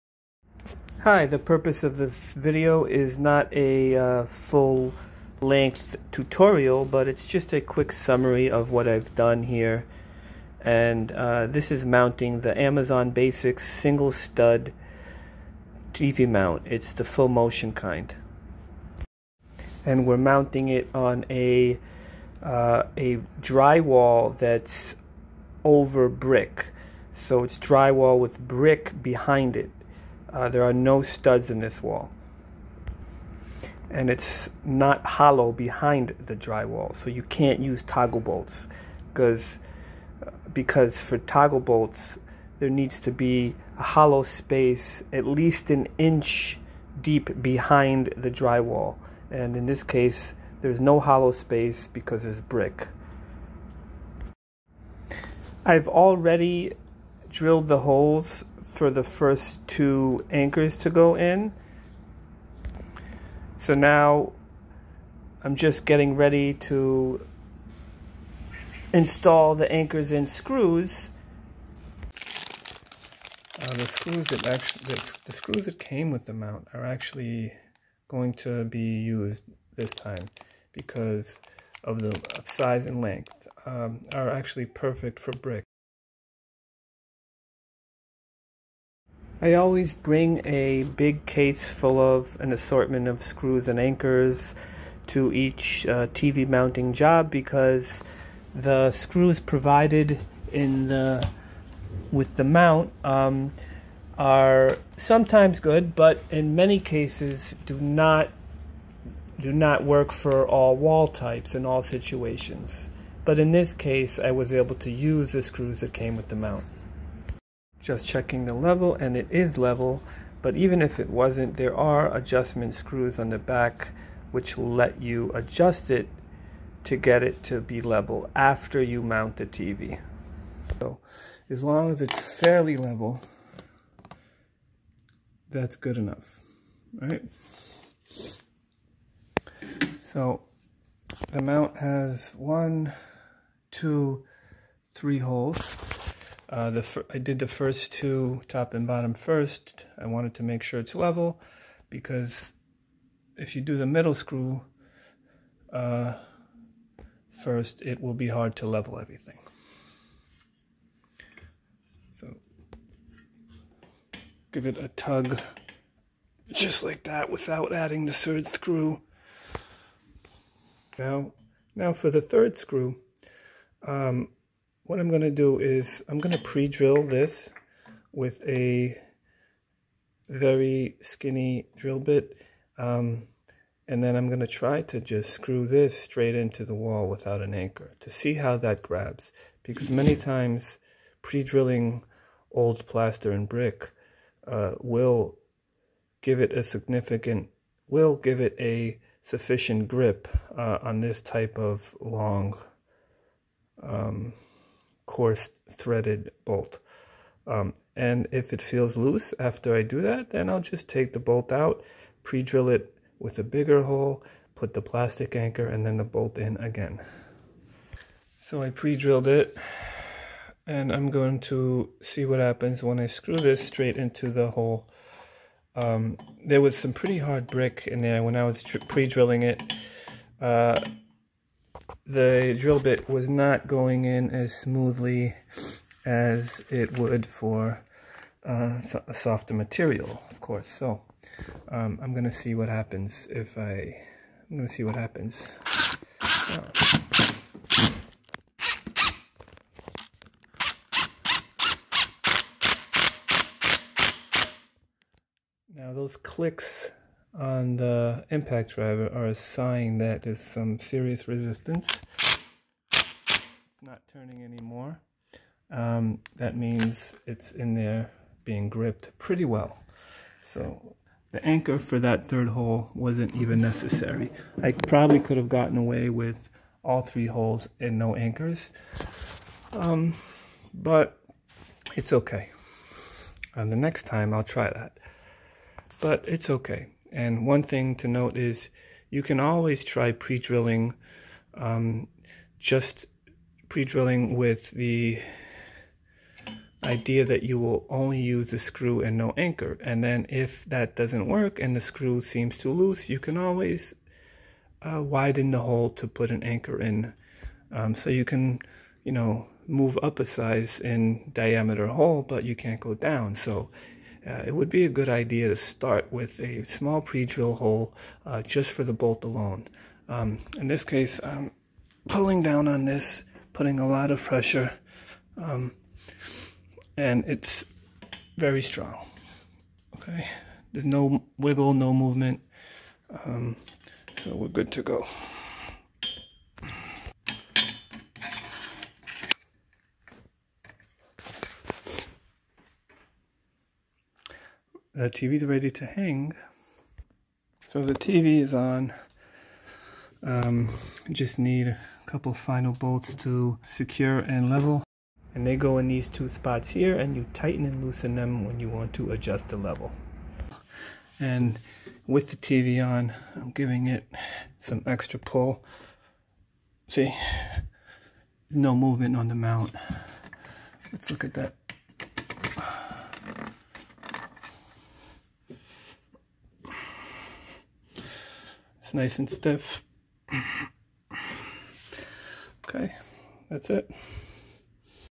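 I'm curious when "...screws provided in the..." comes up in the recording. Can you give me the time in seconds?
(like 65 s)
98 s.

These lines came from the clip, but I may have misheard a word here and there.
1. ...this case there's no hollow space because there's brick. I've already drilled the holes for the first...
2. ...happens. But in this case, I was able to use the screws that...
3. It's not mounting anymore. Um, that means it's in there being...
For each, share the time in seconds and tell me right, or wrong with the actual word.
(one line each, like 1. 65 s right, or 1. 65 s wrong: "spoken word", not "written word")
1. 49 s right
2. 111 s wrong: "situations", not "happens"
3. 262 s wrong: "turning", not "mounting".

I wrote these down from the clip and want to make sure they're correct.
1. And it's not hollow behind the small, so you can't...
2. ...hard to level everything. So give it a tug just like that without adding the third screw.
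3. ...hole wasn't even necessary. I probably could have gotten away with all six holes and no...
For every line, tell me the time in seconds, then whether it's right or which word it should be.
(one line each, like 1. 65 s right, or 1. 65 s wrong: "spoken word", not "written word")
1. 33 s wrong: "drywall", not "small"
2. 158 s right
3. 272 s wrong: "three", not "six".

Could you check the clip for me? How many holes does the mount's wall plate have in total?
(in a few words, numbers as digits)
3.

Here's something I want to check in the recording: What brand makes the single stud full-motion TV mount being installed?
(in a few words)
Amazon Basics.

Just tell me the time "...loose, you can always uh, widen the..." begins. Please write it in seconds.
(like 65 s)
302 s.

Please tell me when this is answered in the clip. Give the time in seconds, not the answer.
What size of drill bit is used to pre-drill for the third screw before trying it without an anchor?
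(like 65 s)
180 s.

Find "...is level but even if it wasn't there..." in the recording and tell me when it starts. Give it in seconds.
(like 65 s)
119 s.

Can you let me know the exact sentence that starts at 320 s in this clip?
Um, in this case, I'm pulling down on this, putting a lot of pressure, um, and it's very strong.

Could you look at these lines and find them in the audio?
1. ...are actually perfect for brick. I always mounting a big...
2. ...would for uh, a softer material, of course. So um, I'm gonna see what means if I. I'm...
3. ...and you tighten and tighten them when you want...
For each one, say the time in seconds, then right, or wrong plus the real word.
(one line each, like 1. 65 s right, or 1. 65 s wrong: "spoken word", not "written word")
1. 84 s wrong: "bring", not "mounting"
2. 236 s wrong: "happens", not "means"
3. 356 s wrong: "loosen", not "tighten".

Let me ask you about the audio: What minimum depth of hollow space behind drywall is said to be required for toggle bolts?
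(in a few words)
an inch.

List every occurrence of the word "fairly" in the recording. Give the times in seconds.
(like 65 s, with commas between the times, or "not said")
132 s.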